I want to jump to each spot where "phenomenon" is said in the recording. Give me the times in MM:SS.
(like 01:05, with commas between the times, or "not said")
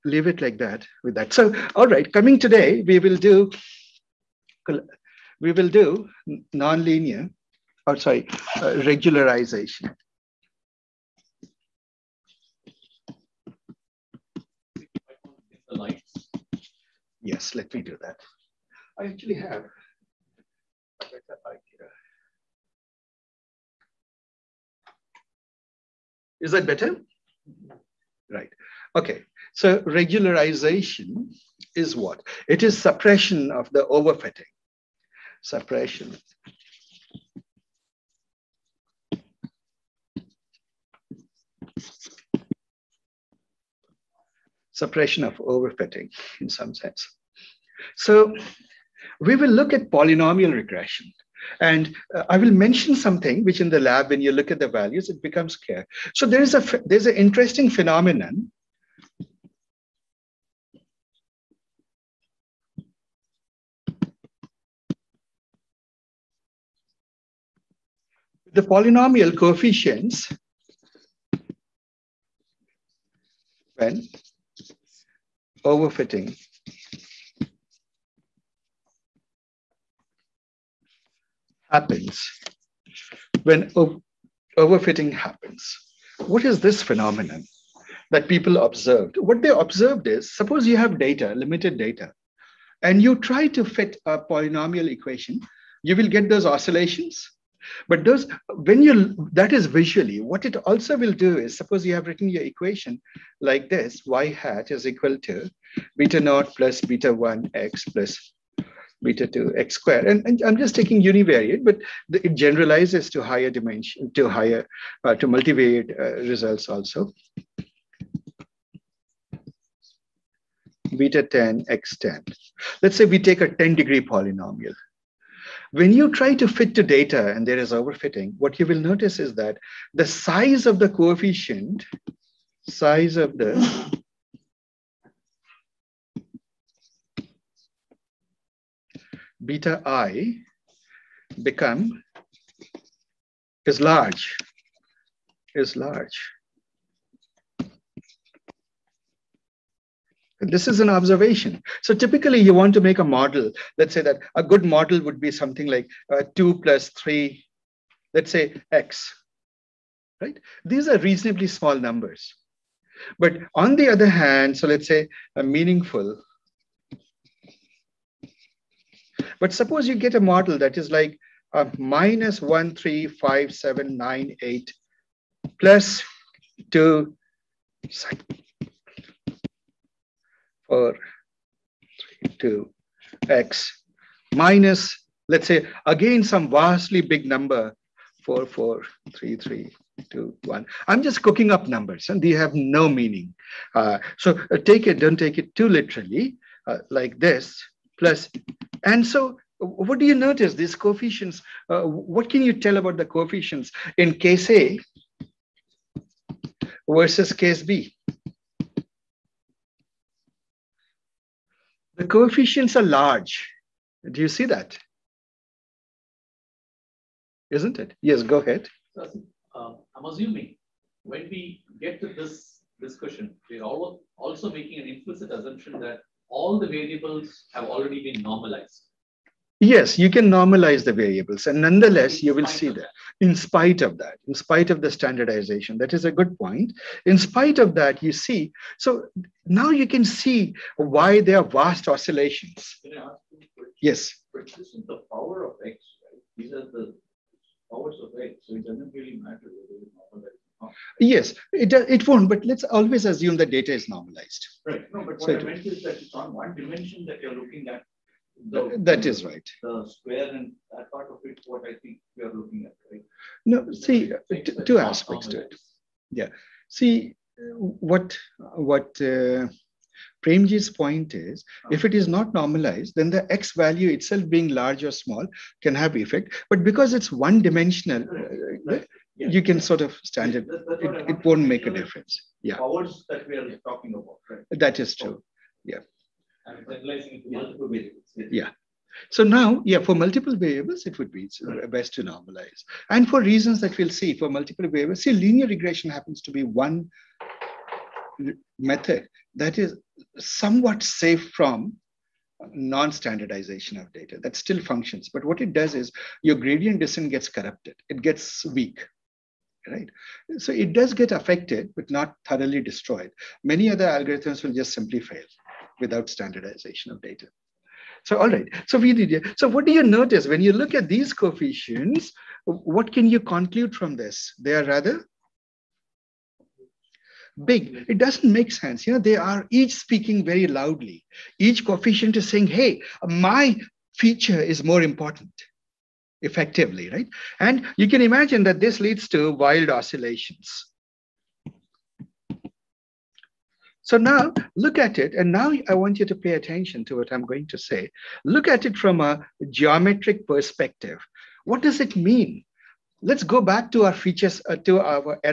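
00:57, 01:26.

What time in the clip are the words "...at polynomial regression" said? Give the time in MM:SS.
00:49.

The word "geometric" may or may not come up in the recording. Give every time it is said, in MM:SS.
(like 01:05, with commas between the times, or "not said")
05:49.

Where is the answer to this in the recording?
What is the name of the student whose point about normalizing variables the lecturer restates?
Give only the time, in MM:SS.
04:30.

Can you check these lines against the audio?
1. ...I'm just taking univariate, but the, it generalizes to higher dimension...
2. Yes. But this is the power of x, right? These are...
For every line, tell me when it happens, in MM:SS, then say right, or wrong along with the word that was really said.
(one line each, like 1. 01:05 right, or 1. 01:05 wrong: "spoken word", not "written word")
1. 01:50 right
2. 04:03 right.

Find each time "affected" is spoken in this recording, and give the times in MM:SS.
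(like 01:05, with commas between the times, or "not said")
05:11.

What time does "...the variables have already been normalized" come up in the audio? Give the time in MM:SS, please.
03:46.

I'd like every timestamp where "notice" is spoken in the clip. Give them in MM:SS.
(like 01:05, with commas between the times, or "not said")
02:08, 03:20, 05:19.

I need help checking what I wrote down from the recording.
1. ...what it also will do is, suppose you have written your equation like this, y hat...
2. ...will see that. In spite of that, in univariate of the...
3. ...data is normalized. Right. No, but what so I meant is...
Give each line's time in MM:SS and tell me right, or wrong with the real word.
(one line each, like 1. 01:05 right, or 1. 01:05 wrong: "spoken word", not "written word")
1. 01:40 right
2. 03:52 wrong: "spite", not "univariate"
3. 04:13 right.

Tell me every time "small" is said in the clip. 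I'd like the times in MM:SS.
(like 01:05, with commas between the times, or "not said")
02:41, 04:34.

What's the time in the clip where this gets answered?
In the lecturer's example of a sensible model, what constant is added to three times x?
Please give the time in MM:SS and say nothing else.
02:36.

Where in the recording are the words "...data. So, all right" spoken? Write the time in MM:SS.
05:17.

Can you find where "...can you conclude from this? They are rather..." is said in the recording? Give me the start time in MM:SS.
05:22.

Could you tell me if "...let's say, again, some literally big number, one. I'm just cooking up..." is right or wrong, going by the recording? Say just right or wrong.
wrong.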